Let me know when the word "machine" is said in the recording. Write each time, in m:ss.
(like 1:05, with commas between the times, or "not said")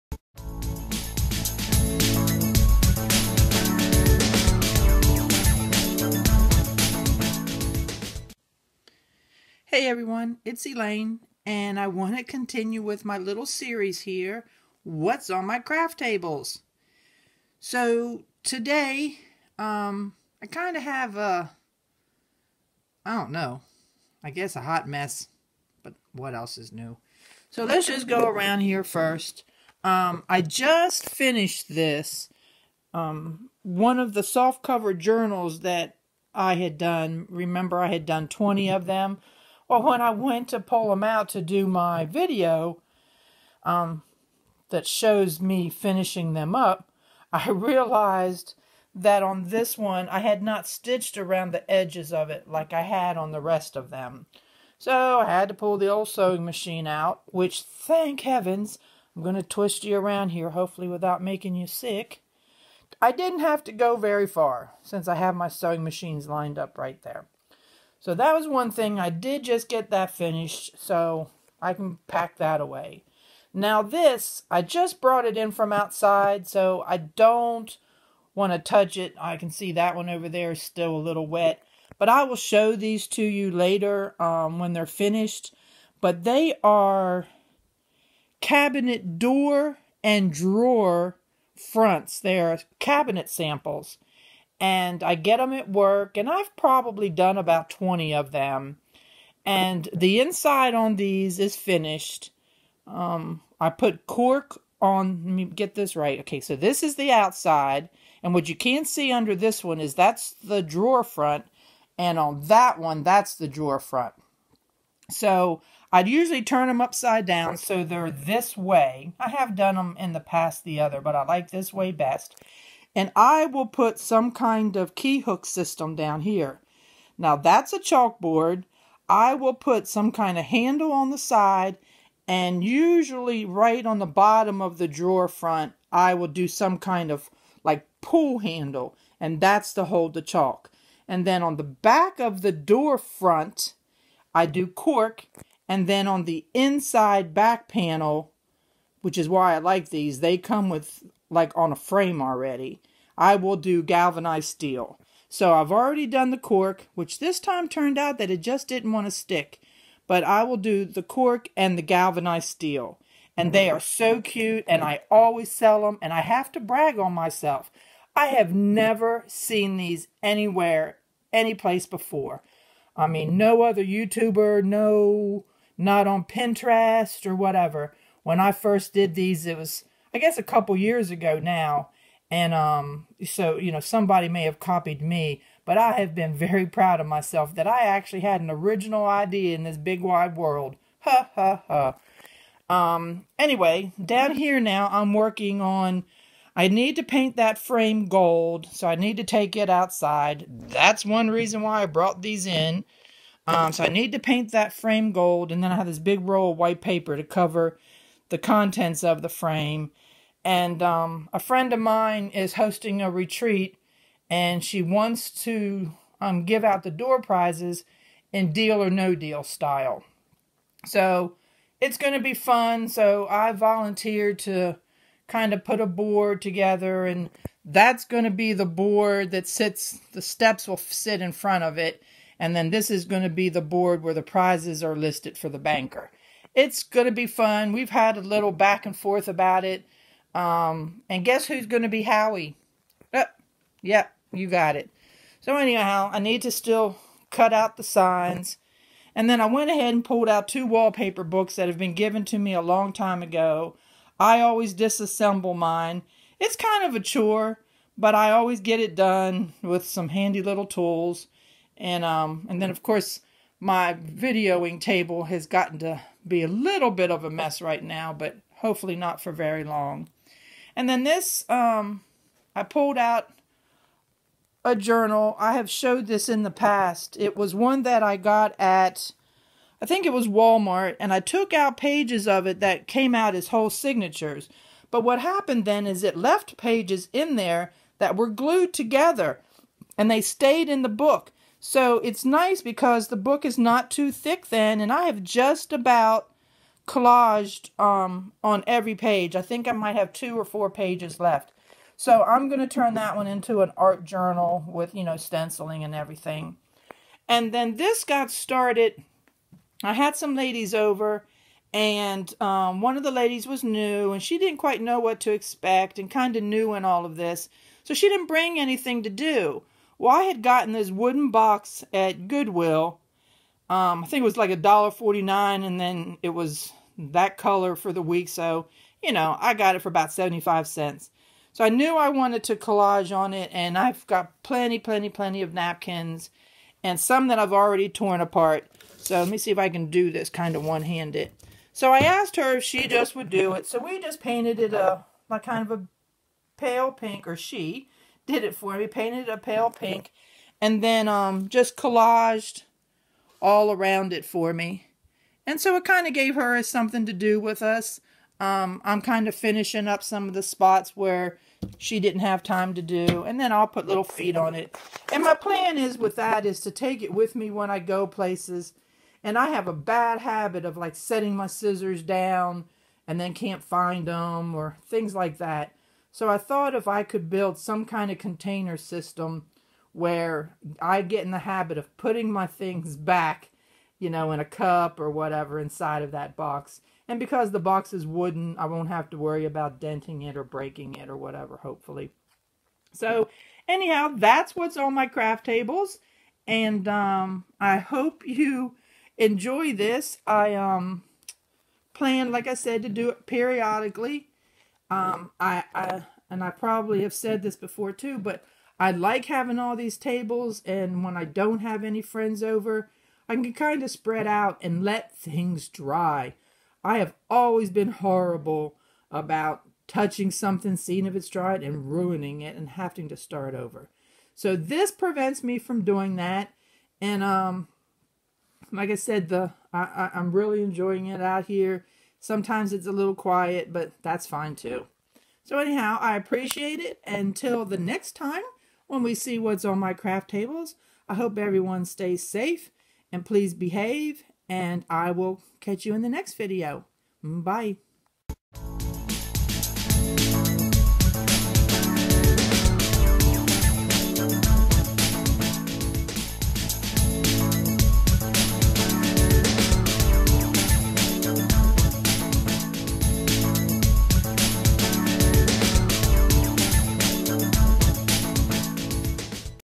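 0:56, 1:05.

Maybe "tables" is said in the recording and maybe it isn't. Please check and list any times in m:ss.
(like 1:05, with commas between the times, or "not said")
0:15, 4:24, 6:35, 6:49, 7:20.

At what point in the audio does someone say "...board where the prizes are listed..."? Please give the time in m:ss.
3:53.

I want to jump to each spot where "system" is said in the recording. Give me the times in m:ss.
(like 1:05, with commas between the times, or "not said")
2:05, 6:18.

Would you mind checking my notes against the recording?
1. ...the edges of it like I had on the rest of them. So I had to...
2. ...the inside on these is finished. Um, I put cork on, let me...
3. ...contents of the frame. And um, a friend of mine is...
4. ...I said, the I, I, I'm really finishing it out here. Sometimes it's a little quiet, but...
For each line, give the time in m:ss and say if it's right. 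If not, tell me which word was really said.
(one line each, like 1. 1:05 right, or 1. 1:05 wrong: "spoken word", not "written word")
1. 0:51 right
2. 1:39 right
3. 3:28 right
4. 7:08 wrong: "enjoying", not "finishing".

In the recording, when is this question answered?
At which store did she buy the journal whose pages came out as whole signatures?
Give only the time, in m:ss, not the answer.
4:40.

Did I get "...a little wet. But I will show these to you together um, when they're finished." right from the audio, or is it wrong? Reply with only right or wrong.
wrong.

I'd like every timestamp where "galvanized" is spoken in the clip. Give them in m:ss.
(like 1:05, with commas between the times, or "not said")
2:33, 2:41.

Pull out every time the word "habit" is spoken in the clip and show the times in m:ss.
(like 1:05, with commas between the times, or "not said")
6:10, 6:21.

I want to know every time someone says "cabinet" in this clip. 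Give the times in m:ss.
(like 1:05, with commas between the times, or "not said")
1:28, 1:32.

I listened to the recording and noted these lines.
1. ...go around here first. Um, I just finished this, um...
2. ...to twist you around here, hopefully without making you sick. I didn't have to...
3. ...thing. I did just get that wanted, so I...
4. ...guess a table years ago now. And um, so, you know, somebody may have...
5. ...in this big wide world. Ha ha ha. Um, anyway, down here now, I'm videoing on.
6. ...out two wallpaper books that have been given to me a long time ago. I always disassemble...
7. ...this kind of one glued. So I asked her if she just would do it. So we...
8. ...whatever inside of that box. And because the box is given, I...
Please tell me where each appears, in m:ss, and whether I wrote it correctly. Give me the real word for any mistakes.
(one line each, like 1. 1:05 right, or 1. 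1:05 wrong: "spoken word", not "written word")
1. 0:28 right
2. 0:59 right
3. 1:08 wrong: "finished", not "wanted"
4. 3:00 wrong: "couple", not "table"
5. 3:09 wrong: "working", not "videoing"
6. 4:10 right
7. 5:40 wrong: "handed", not "glued"
8. 6:25 wrong: "wooden", not "given".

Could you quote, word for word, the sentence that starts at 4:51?
So it's nice because the book is not too thick then, and I have just about collaged um, on every page.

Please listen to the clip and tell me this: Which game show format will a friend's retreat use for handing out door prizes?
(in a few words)
Deal or No Deal.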